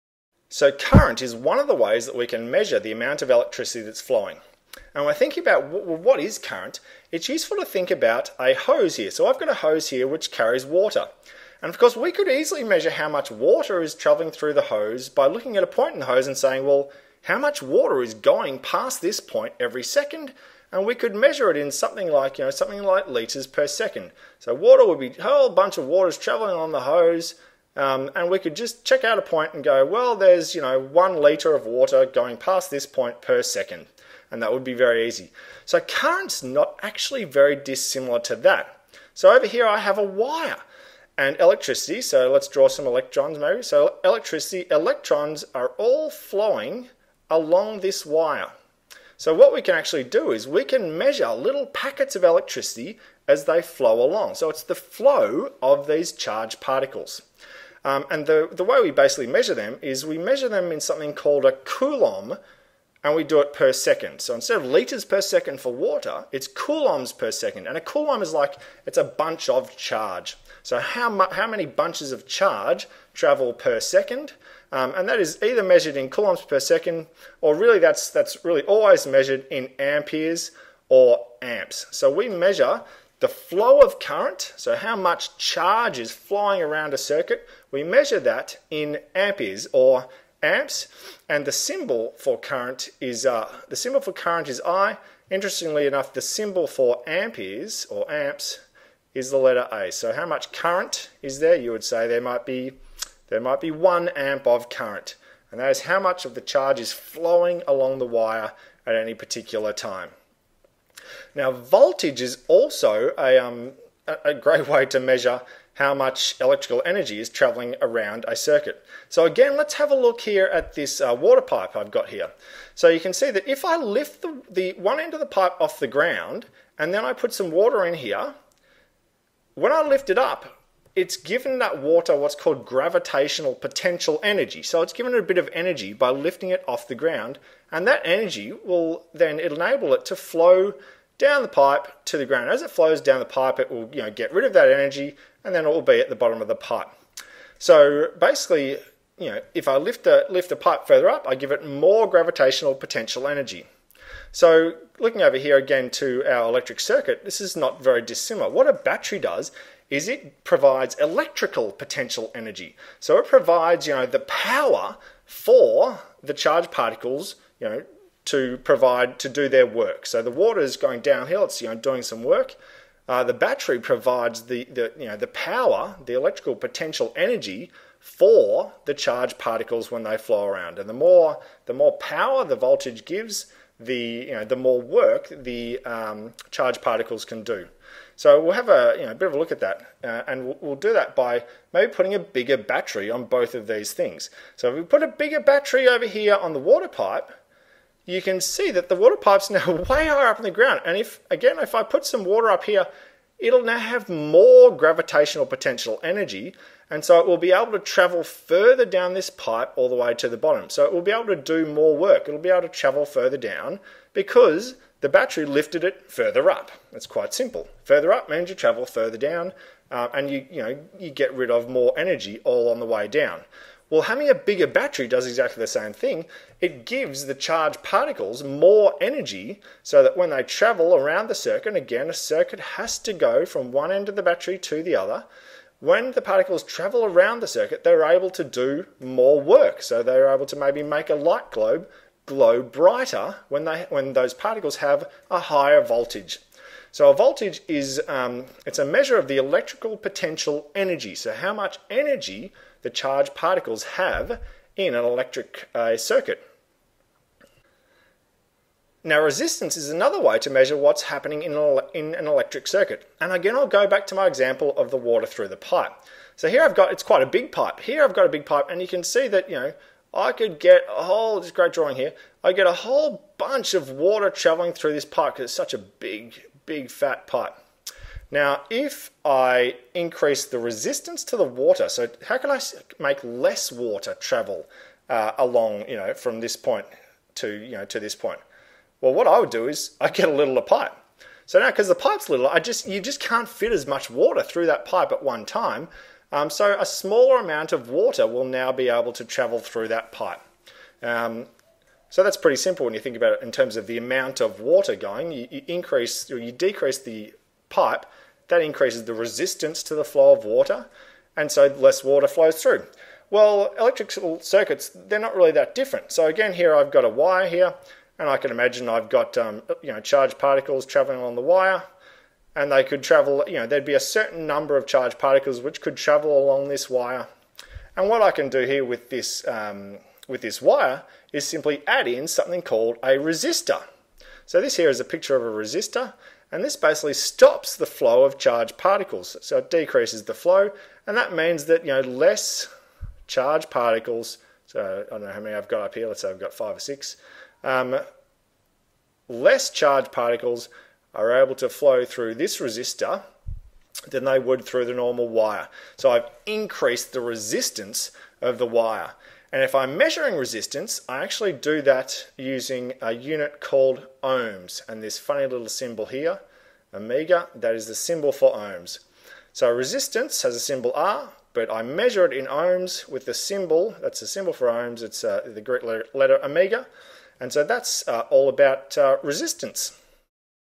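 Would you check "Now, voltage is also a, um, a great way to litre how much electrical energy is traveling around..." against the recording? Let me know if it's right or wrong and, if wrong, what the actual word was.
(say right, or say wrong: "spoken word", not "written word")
wrong: "measure", not "litre".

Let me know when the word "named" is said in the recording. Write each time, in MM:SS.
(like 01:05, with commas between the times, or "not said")
not said.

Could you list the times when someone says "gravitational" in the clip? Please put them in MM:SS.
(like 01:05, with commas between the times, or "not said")
02:12, 02:32, 03:24.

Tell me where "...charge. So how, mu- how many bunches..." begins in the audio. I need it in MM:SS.
01:09.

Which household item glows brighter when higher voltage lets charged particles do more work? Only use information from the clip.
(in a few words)
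light globe.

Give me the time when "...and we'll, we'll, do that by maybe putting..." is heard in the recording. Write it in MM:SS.
03:10.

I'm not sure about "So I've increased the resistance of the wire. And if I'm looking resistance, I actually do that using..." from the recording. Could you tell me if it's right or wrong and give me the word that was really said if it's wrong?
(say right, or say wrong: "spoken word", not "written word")
wrong: "measuring", not "looking".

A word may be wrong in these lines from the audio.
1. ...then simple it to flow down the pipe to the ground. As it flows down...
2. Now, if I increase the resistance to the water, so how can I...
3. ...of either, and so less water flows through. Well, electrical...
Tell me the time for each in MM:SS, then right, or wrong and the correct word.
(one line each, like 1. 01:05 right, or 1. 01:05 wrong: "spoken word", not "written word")
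1. 02:19 wrong: "enable", not "simple"
2. 04:38 right
3. 05:10 wrong: "water", not "either".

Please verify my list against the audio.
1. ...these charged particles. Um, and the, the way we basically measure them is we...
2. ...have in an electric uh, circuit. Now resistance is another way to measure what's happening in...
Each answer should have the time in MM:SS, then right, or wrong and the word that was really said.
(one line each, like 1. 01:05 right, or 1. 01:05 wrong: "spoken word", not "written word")
1. 00:55 right
2. 04:13 right.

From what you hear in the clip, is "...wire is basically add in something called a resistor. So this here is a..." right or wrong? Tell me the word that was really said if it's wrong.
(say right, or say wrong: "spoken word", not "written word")
wrong: "simply", not "basically".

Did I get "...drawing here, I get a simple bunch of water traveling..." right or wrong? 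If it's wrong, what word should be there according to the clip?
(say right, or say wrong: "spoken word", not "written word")
wrong: "whole", not "simple".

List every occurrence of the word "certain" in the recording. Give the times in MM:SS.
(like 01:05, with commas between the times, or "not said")
05:24.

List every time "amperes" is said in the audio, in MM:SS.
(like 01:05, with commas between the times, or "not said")
01:19, 01:29, 01:37.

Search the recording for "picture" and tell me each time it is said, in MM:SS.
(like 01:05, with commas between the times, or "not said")
05:35.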